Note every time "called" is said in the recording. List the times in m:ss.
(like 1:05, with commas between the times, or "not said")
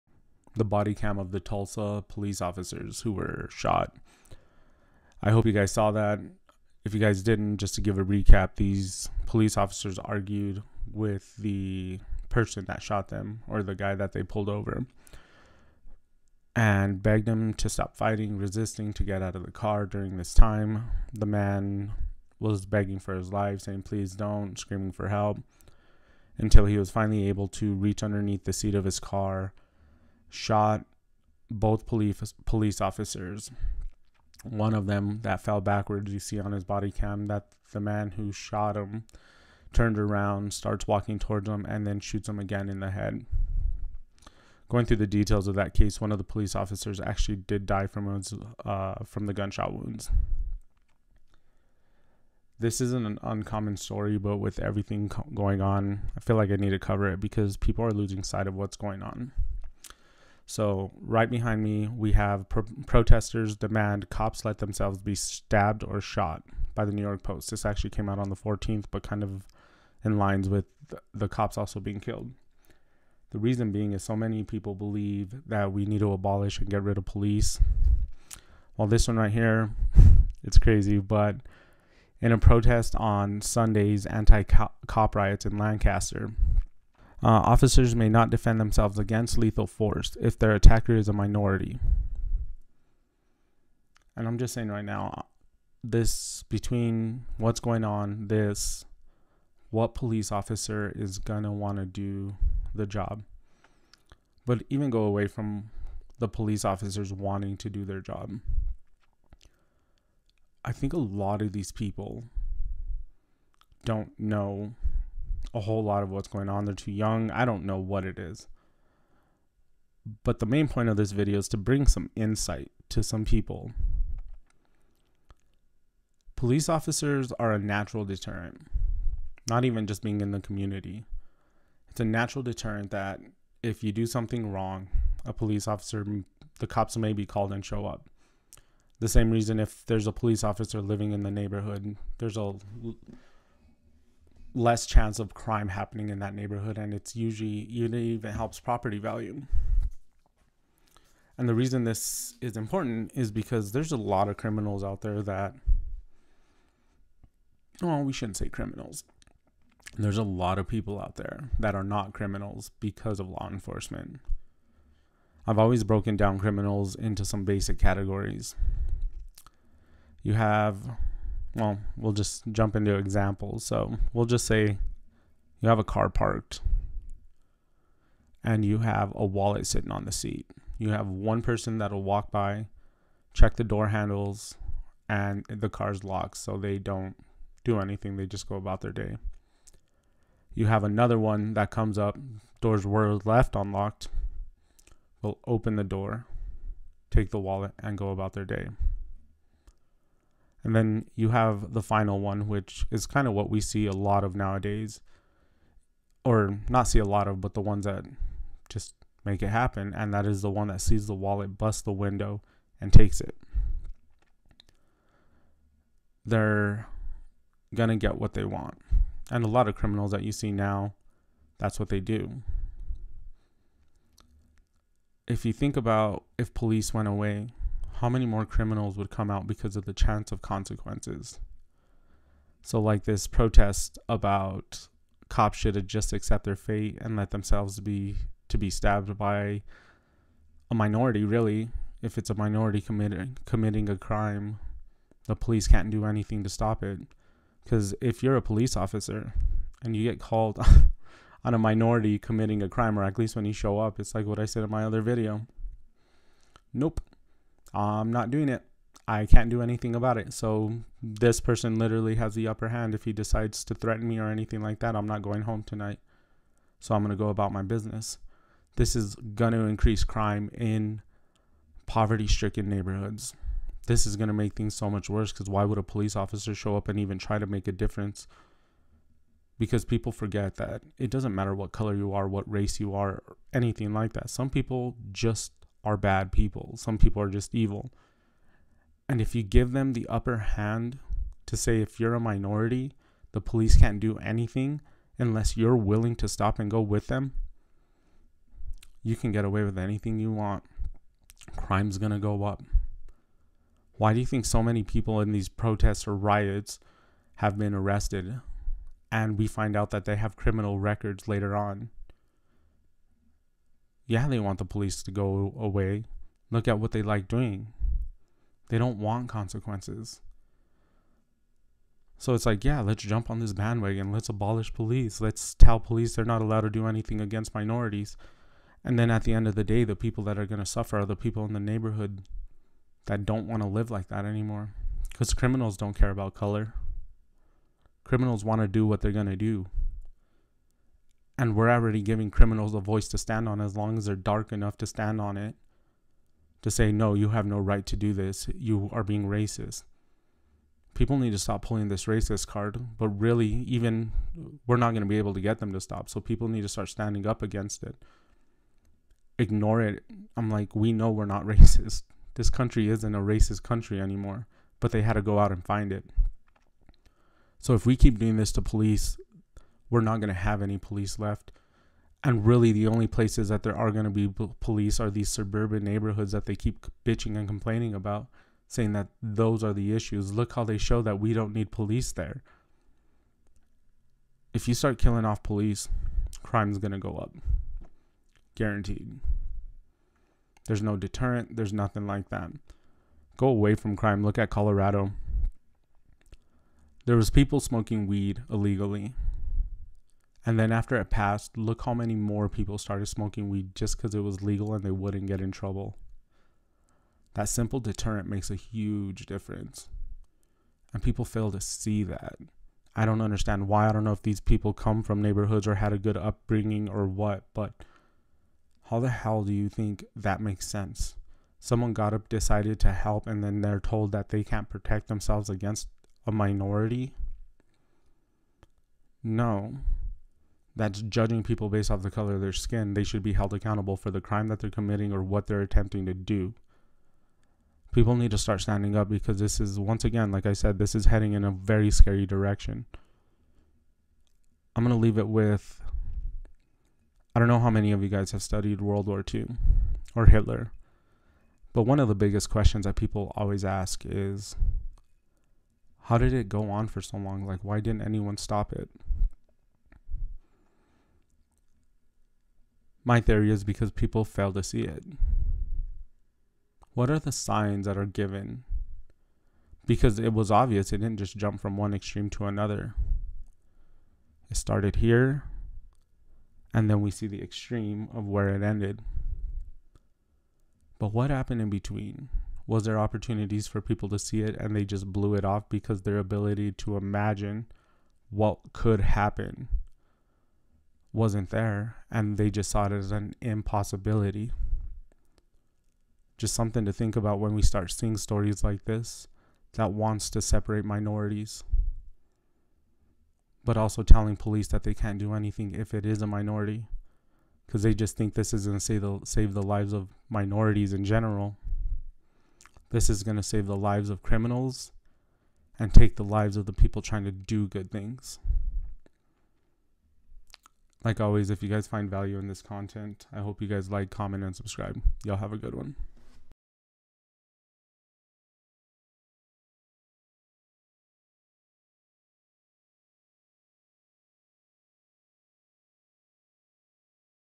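2:17, 4:10.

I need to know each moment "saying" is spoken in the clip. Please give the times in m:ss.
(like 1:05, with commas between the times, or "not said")
0:23, 1:34, 6:18.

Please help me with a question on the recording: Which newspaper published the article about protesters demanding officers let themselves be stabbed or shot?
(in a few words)
New York Post.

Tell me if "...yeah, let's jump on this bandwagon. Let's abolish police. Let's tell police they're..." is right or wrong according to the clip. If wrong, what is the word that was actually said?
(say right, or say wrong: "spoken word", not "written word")
right.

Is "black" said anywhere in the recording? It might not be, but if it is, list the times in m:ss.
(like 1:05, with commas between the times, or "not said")
not said.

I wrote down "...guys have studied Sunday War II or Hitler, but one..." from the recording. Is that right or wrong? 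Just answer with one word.
wrong.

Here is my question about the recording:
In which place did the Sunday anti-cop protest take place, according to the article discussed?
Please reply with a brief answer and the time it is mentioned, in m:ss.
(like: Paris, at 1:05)
Lancaster, at 1:25.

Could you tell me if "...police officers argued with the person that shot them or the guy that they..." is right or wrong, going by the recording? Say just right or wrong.
right.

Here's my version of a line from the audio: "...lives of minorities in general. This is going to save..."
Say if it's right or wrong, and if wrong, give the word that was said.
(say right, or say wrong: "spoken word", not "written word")
right.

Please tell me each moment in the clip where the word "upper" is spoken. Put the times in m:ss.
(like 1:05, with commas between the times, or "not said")
4:22, 4:50.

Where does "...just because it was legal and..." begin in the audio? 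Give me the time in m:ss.
6:43.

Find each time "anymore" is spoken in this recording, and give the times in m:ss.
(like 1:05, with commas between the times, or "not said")
5:34, 6:03.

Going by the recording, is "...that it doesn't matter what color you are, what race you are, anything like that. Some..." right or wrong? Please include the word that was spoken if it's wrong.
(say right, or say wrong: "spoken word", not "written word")
right.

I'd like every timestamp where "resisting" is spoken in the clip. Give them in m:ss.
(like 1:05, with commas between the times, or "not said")
0:18.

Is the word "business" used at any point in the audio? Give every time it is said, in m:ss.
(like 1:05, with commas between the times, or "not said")
4:27.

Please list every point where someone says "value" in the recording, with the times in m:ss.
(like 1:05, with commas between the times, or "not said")
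2:28, 8:42.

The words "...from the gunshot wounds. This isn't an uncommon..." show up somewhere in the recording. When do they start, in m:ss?
0:49.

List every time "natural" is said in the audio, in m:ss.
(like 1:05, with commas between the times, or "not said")
2:07, 2:12.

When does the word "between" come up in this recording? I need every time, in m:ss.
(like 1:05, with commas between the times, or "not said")
1:36, 8:01.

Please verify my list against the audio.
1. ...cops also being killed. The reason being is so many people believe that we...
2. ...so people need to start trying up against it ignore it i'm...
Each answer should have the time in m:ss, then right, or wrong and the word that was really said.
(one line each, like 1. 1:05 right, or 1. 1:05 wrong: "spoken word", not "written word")
1. 1:11 right
2. 5:56 wrong: "standing", not "trying".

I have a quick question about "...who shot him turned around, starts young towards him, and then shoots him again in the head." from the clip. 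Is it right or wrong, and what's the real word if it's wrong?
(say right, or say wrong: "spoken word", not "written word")
wrong: "walking", not "young".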